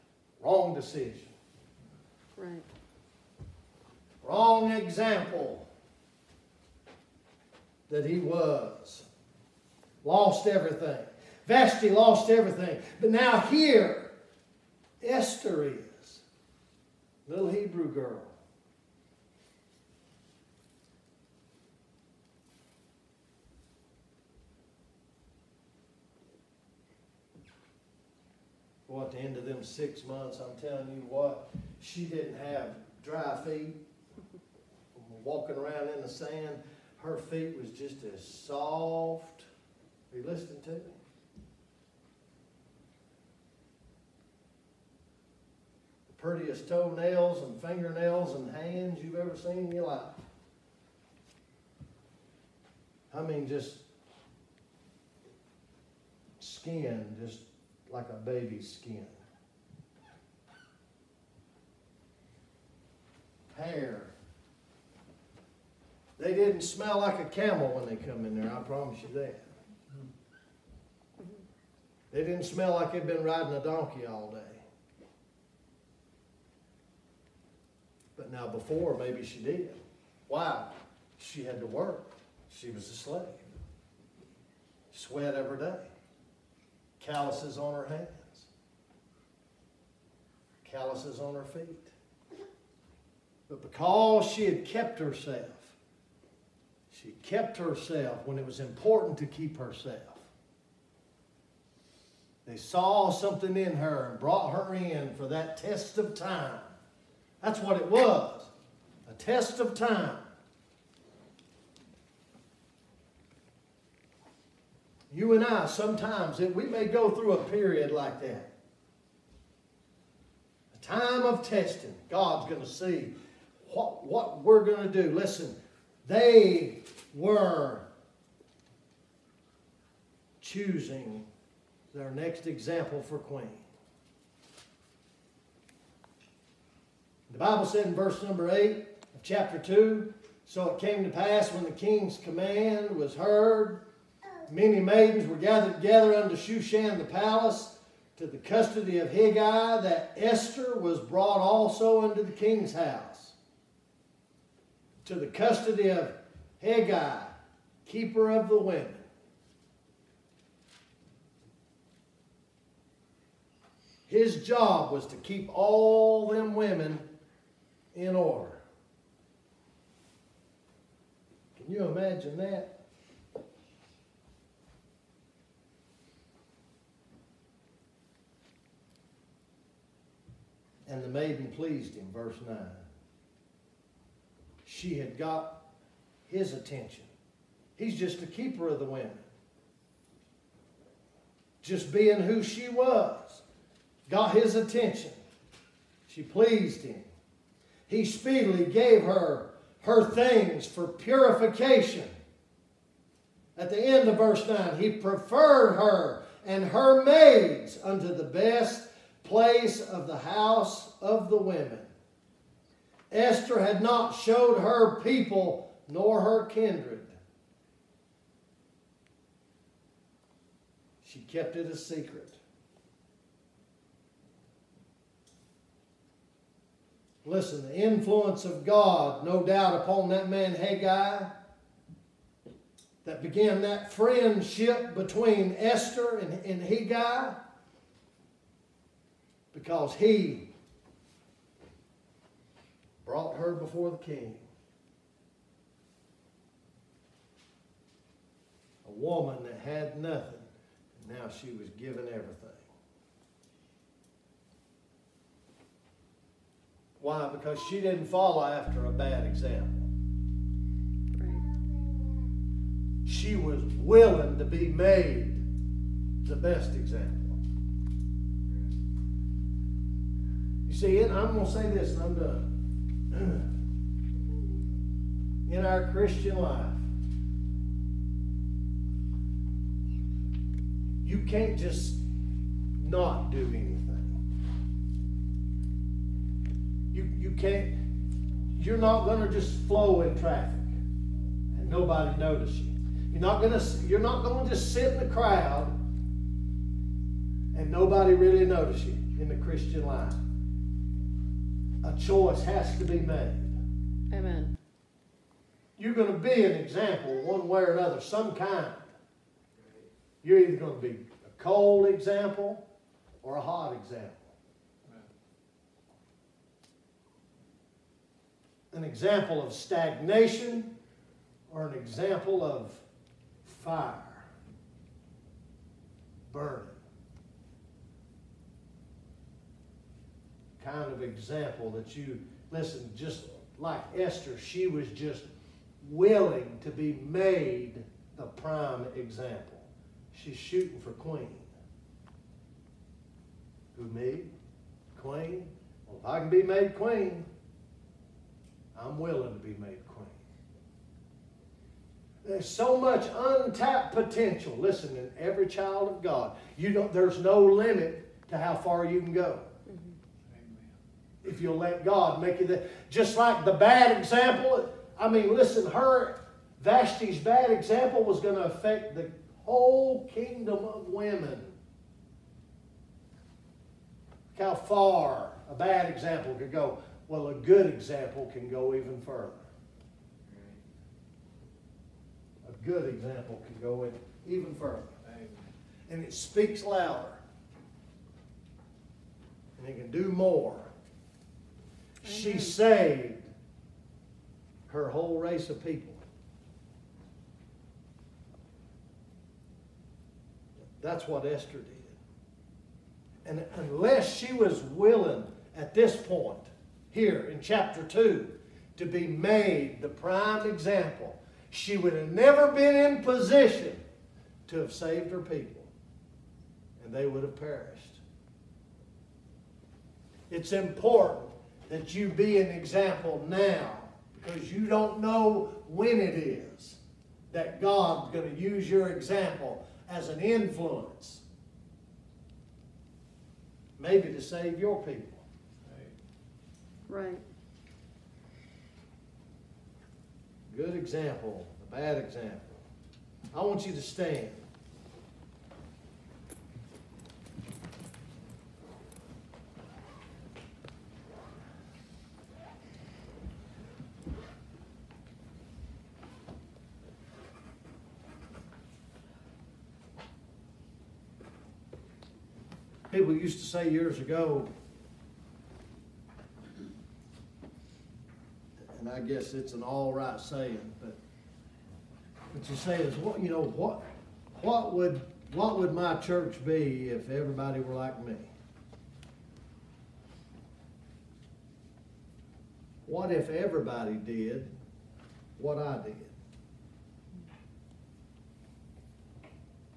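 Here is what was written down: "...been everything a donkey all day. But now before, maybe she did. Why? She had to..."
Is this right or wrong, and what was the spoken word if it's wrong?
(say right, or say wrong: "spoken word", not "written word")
wrong: "riding", not "everything".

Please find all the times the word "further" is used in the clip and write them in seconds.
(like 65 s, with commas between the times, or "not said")
379 s, 384 s.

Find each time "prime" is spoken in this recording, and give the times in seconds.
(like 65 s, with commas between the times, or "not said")
338 s, 409 s.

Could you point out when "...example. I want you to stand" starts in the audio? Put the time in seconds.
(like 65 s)
441 s.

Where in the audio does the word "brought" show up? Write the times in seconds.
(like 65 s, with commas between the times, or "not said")
104 s, 150 s, 243 s.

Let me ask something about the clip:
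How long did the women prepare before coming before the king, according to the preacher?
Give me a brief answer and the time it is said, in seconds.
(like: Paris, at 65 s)
6 months, at 29 s.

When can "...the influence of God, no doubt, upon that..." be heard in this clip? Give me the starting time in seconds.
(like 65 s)
227 s.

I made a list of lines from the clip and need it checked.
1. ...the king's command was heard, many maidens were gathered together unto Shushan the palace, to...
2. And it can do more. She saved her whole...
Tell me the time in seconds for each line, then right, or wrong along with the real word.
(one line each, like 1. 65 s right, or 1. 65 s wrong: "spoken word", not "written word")
1. 141 s right
2. 389 s right.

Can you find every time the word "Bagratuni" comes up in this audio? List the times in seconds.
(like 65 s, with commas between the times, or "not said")
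not said.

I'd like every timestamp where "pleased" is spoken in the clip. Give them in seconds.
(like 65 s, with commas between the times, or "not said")
181 s, 196 s.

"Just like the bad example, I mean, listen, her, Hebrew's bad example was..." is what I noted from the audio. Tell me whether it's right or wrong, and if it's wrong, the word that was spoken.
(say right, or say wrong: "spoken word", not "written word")
wrong: "Vashti", not "Hebrew".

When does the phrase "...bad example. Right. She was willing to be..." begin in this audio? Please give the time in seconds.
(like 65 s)
258 s.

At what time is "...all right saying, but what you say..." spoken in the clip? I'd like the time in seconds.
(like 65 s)
469 s.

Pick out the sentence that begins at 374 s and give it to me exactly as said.
Look how far a bad example could go.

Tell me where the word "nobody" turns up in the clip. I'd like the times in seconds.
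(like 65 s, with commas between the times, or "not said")
291 s, 297 s.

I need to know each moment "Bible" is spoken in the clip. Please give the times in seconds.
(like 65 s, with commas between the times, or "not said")
137 s.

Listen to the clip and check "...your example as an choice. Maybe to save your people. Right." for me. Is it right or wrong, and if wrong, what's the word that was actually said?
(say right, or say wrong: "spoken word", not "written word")
wrong: "influence", not "choice".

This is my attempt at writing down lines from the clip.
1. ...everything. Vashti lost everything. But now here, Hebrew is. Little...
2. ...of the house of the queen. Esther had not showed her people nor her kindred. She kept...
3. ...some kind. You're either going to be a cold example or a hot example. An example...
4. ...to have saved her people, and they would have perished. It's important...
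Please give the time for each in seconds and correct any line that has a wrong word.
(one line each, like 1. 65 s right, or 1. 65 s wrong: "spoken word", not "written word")
1. 10 s wrong: "Esther", not "Hebrew"
2. 209 s wrong: "women", not "queen"
3. 307 s right
4. 414 s right.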